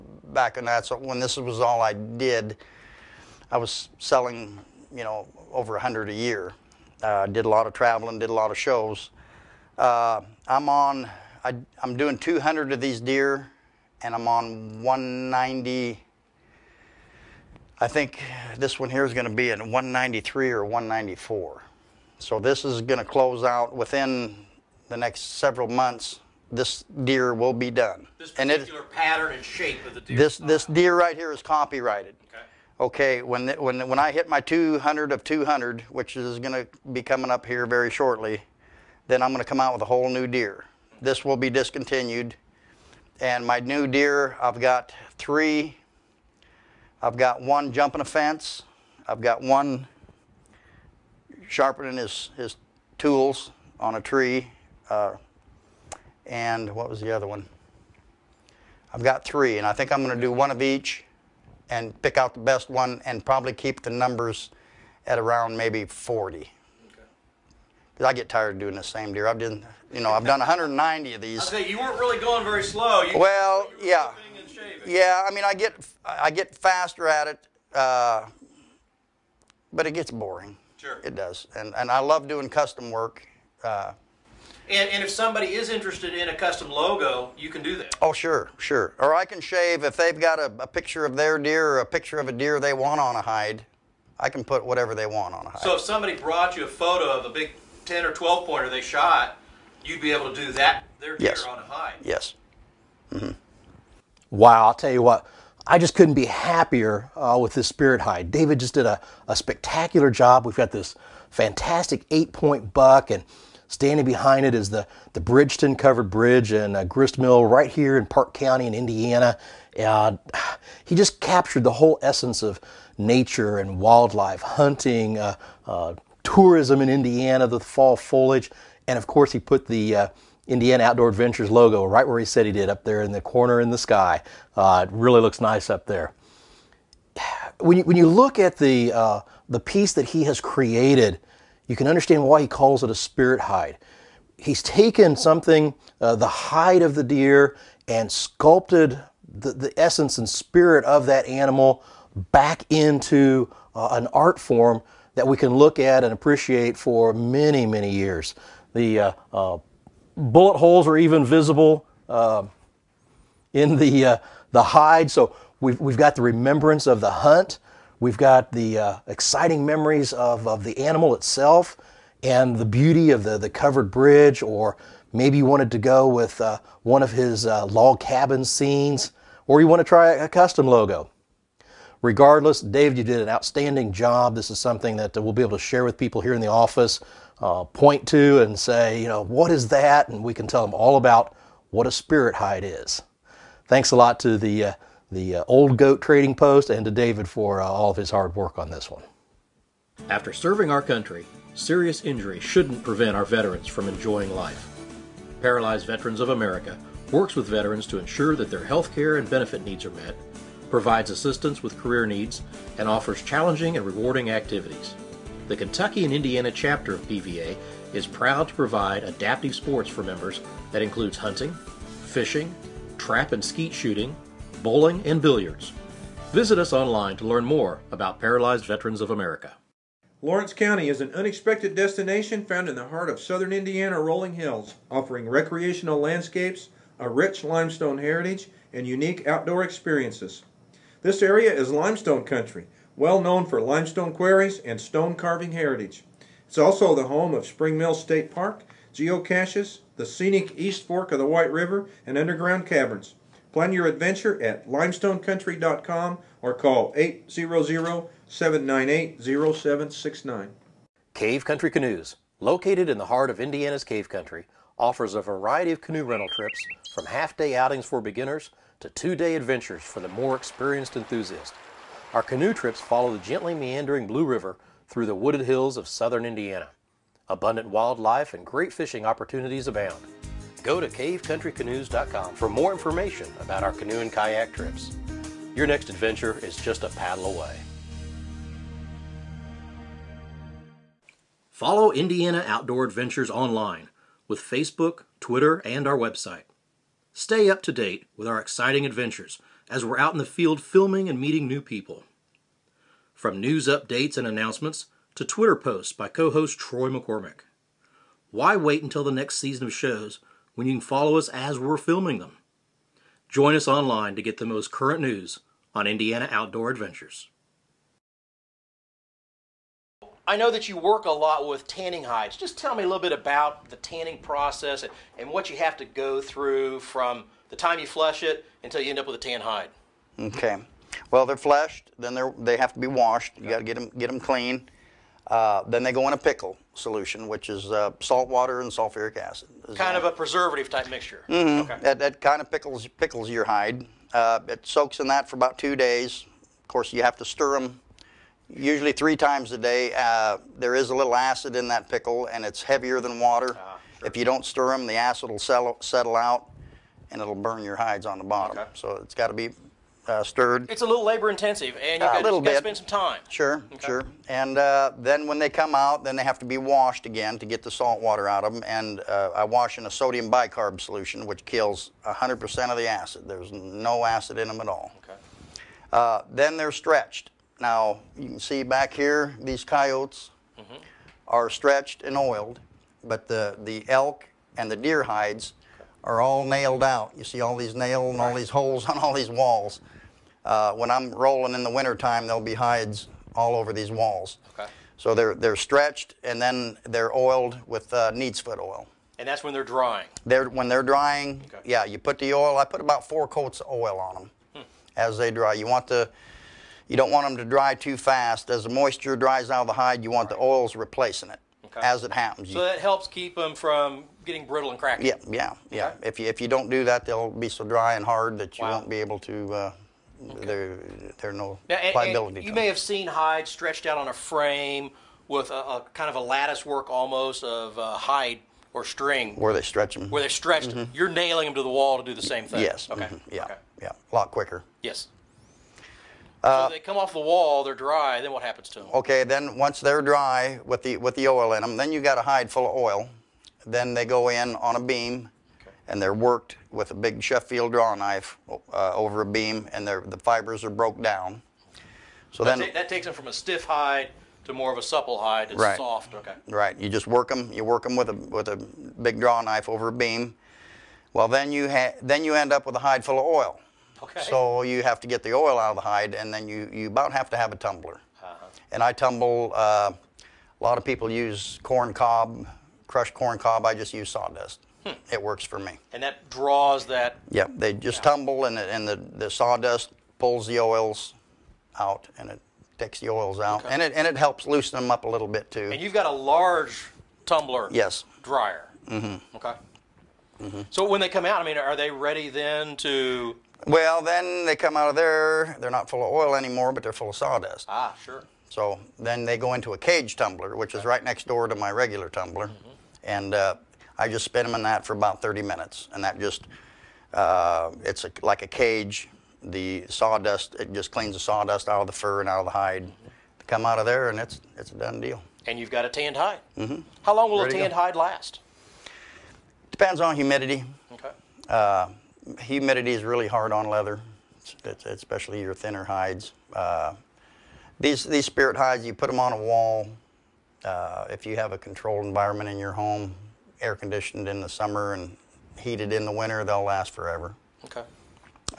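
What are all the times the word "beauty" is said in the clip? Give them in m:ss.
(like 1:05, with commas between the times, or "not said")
2:52.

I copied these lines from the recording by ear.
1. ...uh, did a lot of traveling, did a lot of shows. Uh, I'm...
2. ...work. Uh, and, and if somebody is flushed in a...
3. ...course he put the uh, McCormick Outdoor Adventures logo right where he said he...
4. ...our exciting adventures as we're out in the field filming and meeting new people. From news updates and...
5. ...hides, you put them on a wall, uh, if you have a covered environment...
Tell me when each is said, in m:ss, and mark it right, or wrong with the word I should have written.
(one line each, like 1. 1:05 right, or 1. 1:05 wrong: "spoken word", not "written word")
1. 0:07 right
2. 1:22 wrong: "interested", not "flushed"
3. 2:09 wrong: "Indiana", not "McCormick"
4. 4:58 right
5. 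8:48 wrong: "controlled", not "covered".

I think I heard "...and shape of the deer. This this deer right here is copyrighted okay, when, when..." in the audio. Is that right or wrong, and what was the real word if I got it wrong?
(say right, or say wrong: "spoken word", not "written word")
right.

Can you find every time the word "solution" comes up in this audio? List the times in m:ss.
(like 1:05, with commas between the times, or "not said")
5:36, 6:10.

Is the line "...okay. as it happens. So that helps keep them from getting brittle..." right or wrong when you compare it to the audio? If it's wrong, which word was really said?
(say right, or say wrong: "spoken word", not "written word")
right.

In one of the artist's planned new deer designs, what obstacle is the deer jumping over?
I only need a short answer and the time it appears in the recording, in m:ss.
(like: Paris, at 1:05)
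A fence, at 0:48.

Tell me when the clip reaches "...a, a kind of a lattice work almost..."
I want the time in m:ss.
7:05.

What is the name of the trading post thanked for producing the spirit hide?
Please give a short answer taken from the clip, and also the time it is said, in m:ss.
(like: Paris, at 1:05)
Old Goat Trading Post, at 3:15.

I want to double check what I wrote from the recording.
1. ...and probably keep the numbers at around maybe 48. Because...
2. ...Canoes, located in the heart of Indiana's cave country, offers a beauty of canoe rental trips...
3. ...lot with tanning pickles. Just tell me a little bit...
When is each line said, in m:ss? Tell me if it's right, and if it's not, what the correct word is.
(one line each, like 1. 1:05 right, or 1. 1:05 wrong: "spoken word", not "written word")
1. 1:03 wrong: "40", not "48"
2. 4:21 wrong: "variety", not "beauty"
3. 5:21 wrong: "hides", not "pickles".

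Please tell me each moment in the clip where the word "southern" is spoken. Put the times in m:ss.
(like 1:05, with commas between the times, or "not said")
3:53, 4:35.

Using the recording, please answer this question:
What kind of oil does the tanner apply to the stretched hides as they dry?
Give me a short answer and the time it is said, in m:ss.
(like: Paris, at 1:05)
Neat's foot oil, at 6:38.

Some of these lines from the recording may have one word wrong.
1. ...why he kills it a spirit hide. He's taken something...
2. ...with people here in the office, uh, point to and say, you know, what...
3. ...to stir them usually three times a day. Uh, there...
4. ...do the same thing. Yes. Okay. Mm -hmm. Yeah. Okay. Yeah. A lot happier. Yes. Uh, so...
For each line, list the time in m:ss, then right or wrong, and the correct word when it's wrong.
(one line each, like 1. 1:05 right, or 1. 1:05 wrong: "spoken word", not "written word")
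1. 2:22 wrong: "calls", not "kills"
2. 3:05 right
3. 5:47 right
4. 7:12 wrong: "quicker", not "happier".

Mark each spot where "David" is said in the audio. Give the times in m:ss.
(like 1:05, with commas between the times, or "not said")
1:48, 3:16.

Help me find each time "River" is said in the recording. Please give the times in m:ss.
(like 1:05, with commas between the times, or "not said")
4:11, 4:34.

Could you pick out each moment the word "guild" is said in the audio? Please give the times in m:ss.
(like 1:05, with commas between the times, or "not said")
not said.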